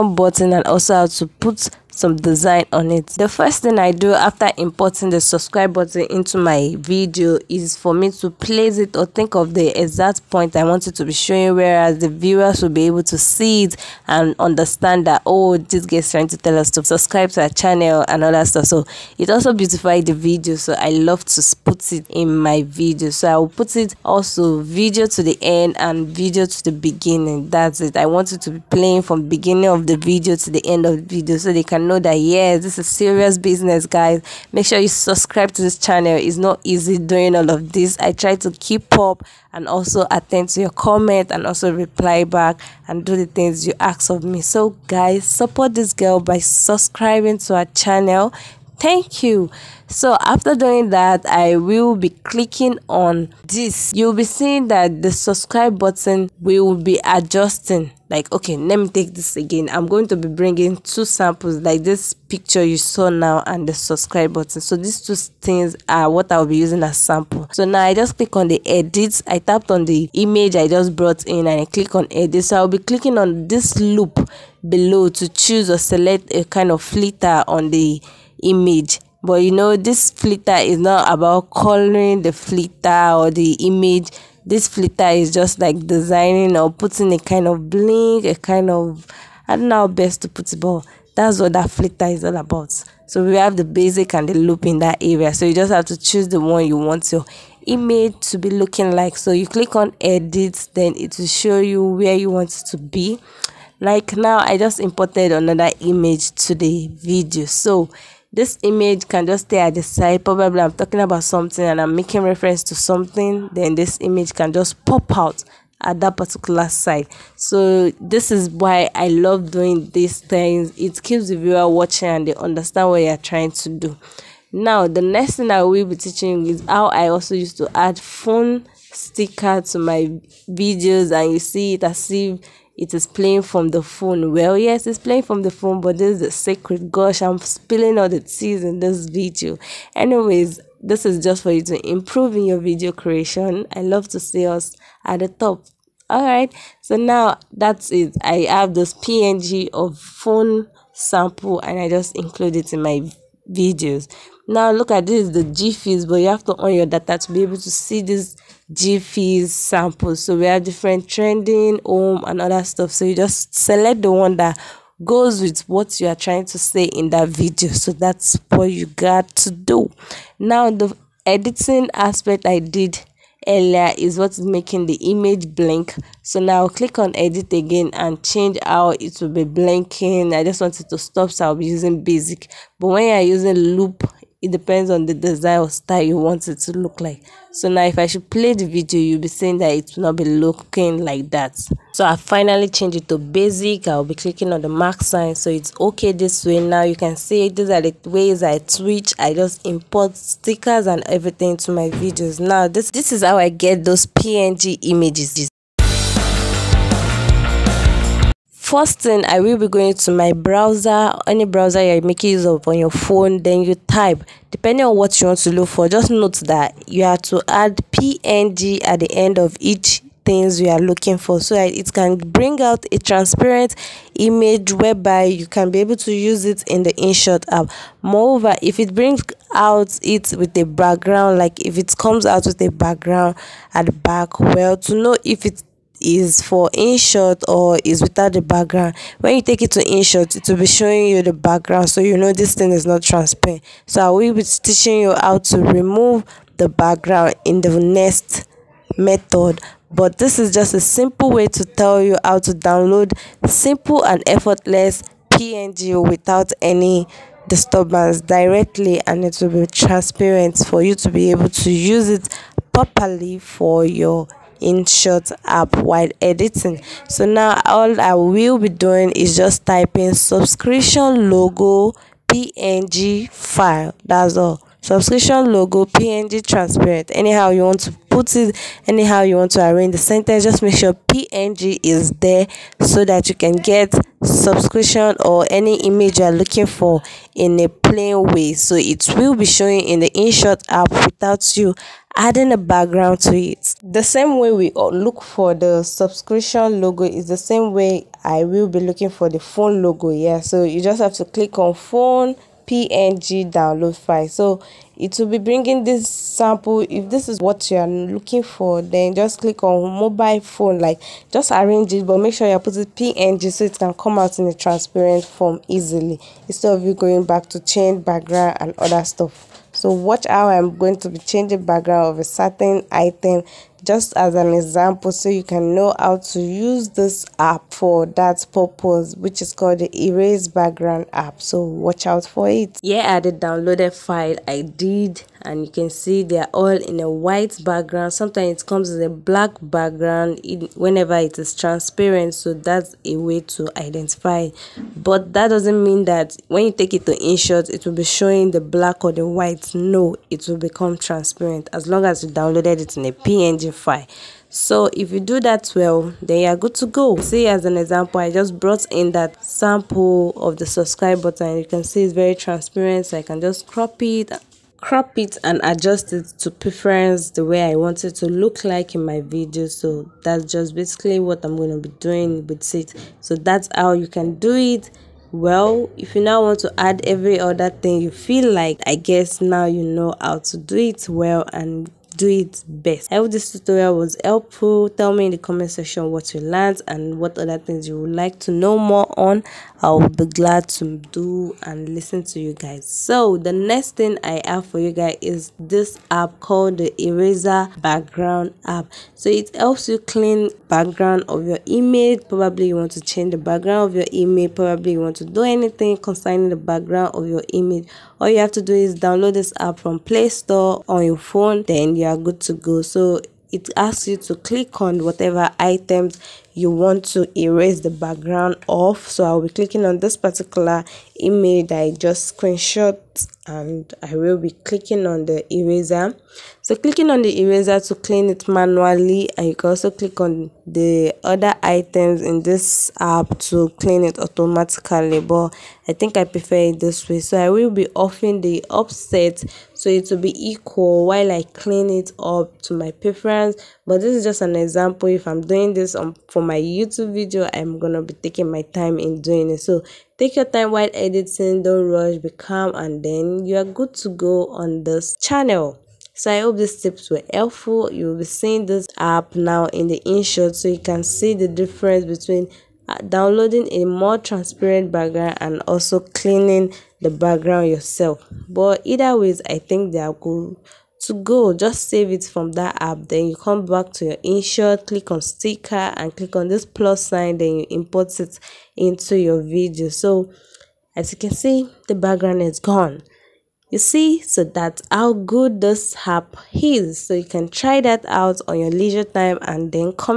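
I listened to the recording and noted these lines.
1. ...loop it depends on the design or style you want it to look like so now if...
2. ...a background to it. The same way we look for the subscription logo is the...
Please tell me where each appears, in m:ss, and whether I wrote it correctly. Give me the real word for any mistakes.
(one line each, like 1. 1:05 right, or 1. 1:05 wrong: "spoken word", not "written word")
1. 3:03 right
2. 4:52 right.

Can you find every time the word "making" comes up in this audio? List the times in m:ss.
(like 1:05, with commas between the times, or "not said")
1:51, 2:54, 3:32.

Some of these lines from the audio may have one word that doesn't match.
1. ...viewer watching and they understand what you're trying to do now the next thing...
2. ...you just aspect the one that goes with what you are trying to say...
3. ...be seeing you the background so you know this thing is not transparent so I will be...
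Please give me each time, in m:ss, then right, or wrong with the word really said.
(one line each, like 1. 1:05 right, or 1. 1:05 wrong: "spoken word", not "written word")
1. 2:01 right
2. 2:43 wrong: "select", not "aspect"
3. 4:00 wrong: "showing", not "seeing".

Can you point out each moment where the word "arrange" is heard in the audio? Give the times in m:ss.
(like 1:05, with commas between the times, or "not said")
4:39, 5:11.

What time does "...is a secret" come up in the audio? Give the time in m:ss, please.
2:16.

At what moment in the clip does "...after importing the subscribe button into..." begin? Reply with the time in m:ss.
0:04.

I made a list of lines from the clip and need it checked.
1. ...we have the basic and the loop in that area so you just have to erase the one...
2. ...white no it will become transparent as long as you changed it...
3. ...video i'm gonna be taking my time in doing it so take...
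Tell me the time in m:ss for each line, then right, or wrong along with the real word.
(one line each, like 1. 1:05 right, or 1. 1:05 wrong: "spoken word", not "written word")
1. 1:33 wrong: "choose", not "erase"
2. 5:49 wrong: "downloaded", not "changed"
3. 7:27 right.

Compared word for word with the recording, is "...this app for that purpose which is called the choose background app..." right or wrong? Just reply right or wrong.
wrong.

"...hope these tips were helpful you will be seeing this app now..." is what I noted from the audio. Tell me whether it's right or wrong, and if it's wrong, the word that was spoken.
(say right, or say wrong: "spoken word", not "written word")
right.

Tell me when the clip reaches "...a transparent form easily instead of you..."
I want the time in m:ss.
5:14.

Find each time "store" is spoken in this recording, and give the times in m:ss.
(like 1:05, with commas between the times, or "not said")
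6:50.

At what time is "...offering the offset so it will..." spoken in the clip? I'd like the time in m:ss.
7:17.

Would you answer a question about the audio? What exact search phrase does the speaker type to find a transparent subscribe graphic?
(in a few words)
subscription logo png transparent.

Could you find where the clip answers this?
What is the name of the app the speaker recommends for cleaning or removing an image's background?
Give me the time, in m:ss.
6:37.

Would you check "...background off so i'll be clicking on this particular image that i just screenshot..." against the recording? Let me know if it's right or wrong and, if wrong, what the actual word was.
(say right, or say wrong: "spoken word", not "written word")
right.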